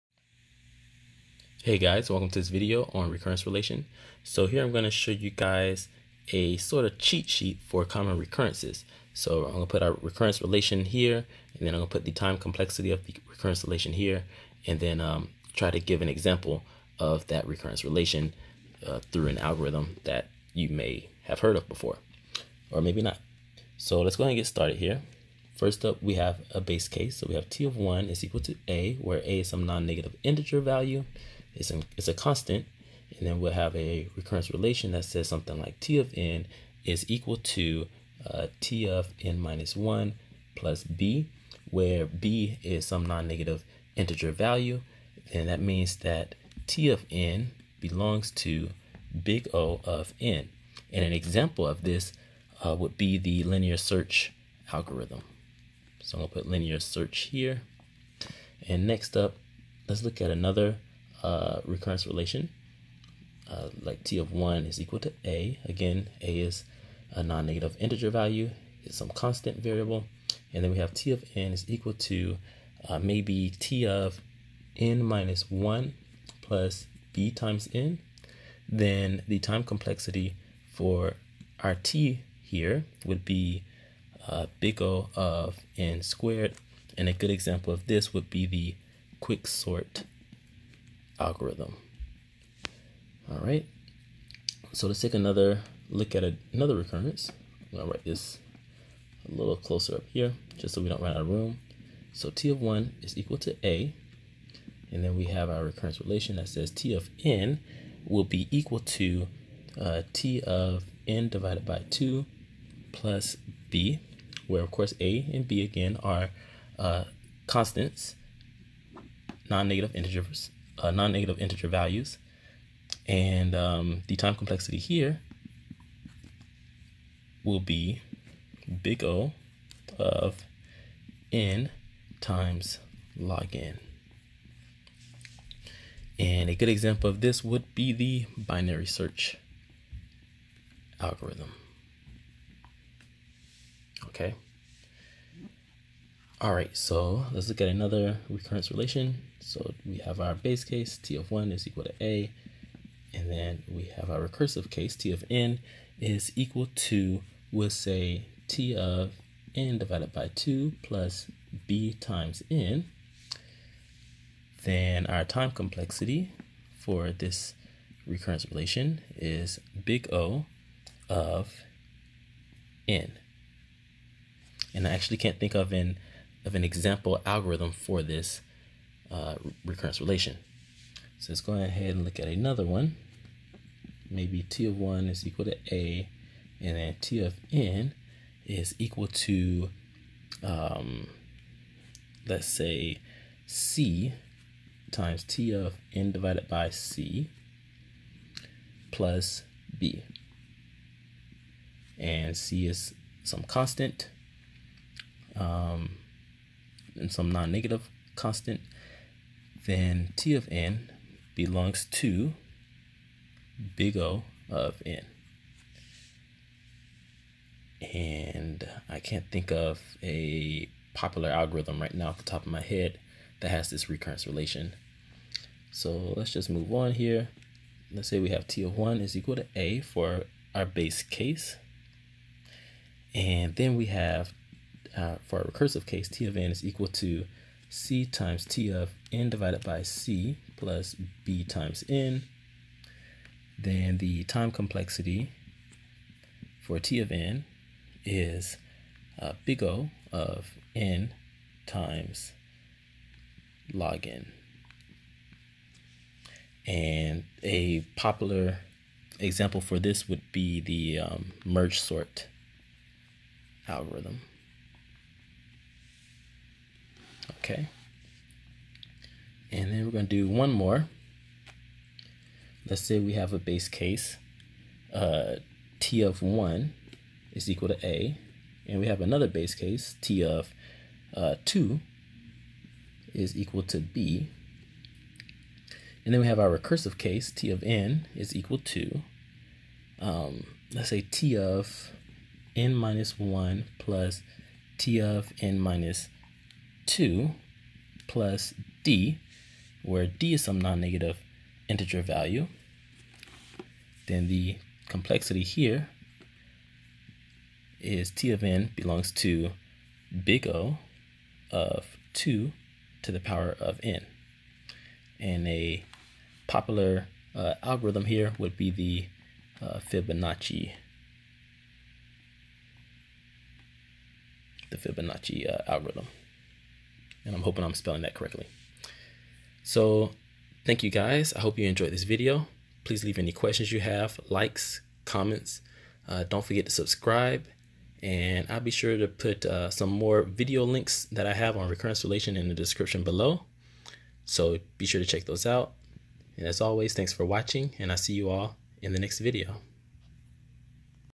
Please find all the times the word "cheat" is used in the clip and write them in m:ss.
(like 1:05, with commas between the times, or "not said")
0:06.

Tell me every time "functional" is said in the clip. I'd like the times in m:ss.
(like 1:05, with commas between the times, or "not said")
not said.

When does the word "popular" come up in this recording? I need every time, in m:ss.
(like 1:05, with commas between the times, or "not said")
3:40, 4:17, 5:16.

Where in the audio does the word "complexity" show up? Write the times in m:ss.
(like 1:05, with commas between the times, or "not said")
0:12, 1:19, 2:04, 2:45, 4:04, 5:04.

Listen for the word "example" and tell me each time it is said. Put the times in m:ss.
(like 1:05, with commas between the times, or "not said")
0:16, 0:51, 1:27, 2:16, 2:56, 4:19.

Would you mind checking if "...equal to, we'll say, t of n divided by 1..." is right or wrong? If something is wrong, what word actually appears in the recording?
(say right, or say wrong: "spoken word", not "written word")
wrong: "2", not "1".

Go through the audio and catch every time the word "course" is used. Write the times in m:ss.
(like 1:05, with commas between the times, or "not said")
1:54.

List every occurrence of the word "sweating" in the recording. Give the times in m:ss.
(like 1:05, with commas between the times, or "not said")
not said.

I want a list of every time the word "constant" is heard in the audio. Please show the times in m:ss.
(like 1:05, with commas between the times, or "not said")
0:32, 1:09, 1:57, 3:23, 3:28.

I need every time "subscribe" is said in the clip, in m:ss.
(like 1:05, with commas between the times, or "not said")
5:36.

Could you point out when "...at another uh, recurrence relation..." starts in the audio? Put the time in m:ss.
1:00.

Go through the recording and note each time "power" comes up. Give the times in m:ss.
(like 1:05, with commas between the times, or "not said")
5:13.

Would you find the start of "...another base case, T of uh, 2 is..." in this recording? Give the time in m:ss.
4:39.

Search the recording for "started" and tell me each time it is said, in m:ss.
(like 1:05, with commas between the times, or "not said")
0:24.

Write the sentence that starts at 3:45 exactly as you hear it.
So let's just move on here.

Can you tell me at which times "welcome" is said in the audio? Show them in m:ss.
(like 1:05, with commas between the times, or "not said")
0:02.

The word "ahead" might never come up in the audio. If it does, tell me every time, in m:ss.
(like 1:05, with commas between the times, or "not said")
0:24, 3:01.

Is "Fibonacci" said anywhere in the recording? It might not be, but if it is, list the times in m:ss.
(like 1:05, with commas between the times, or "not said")
5:19, 5:24.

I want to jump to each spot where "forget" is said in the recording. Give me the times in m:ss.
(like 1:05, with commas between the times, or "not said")
5:36.